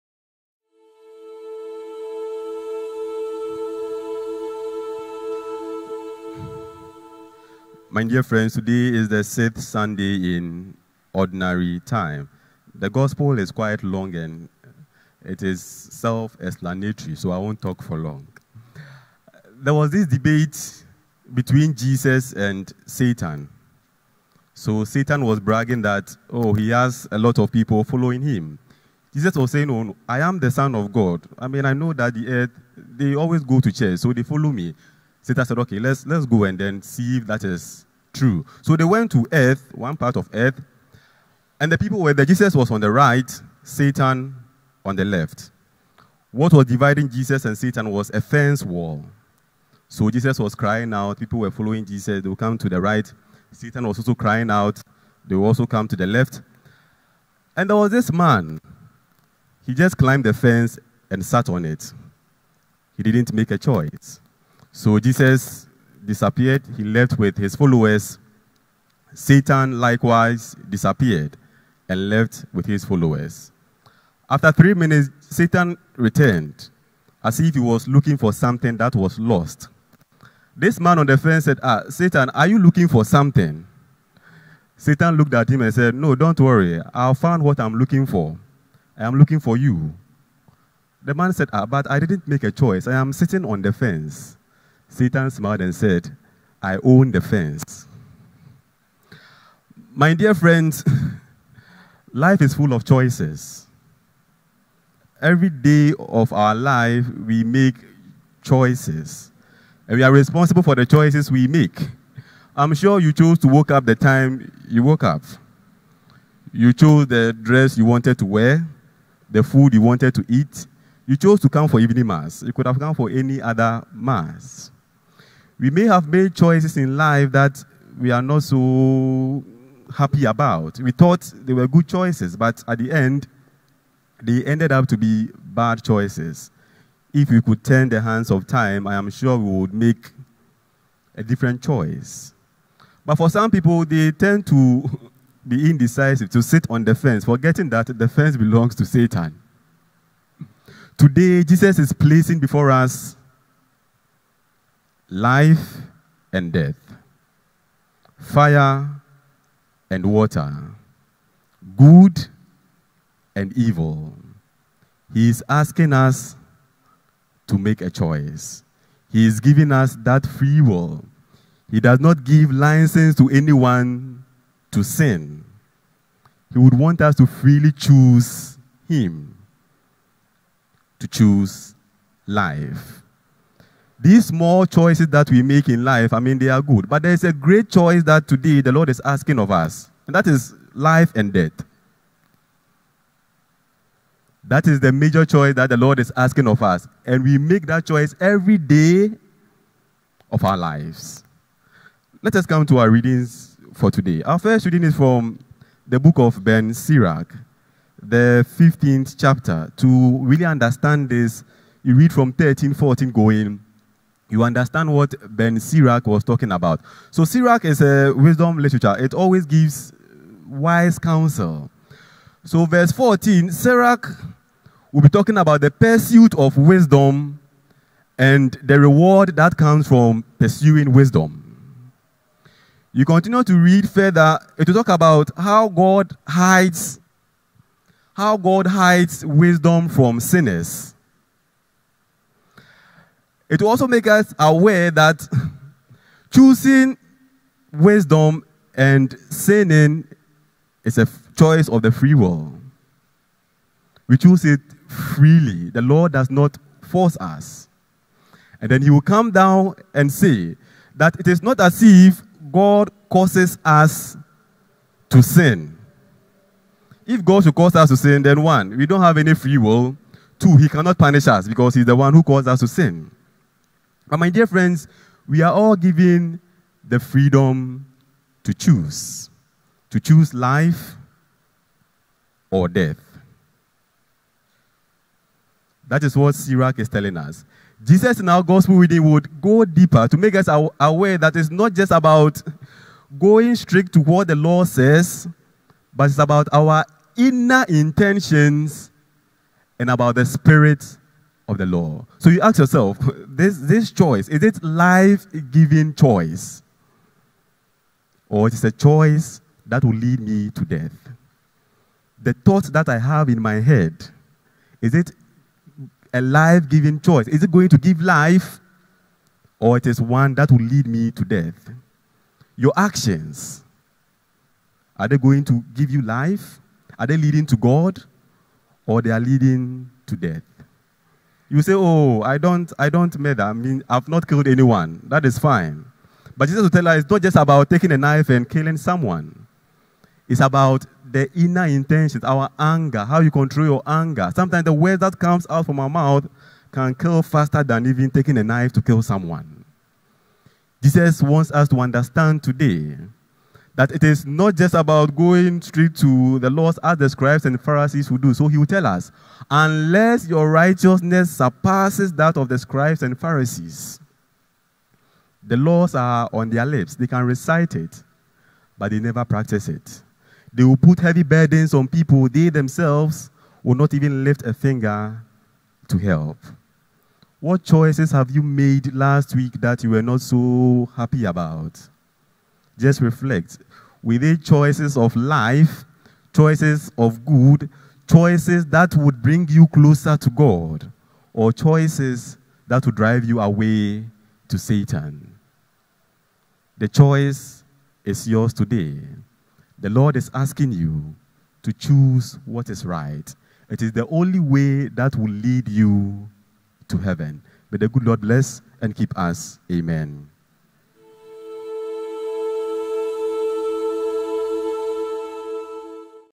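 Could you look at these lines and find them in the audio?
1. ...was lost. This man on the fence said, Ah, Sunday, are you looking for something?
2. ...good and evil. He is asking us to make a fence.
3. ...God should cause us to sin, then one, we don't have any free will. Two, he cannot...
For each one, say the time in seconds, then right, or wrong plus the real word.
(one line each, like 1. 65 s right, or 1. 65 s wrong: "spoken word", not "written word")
1. 78 s wrong: "Satan", not "Sunday"
2. 161 s wrong: "choice", not "fence"
3. 267 s right.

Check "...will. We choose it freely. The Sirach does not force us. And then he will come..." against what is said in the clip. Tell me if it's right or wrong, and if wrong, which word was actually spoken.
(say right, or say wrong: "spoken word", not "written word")
wrong: "Lord", not "Sirach".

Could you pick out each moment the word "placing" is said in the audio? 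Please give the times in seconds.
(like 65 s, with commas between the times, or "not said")
151 s.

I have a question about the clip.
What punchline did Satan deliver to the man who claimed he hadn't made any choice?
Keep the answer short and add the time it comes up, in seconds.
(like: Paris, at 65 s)
I own the fence, at 96 s.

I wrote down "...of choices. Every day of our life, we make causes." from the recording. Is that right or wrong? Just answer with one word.
wrong.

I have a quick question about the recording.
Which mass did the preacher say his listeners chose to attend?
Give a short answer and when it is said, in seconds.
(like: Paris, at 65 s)
evening mass, at 121 s.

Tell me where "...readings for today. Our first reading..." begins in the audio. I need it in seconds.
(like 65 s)
202 s.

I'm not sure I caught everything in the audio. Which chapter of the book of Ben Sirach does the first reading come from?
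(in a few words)
15th.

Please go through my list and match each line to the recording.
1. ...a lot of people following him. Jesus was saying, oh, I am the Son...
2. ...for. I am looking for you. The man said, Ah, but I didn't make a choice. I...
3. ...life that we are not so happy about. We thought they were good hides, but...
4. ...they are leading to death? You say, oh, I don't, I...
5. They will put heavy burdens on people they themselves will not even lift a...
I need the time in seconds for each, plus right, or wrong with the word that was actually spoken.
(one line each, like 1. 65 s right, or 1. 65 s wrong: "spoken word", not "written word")
1. 27 s right
2. 88 s right
3. 126 s wrong: "choices", not "hides"
4. 329 s right
5. 370 s right.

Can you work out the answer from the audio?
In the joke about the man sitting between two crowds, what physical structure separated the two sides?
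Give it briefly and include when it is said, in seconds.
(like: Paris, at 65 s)
fence wall, at 48 s.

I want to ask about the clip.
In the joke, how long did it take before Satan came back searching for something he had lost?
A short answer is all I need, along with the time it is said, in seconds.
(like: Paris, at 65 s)
3 minutes, at 74 s.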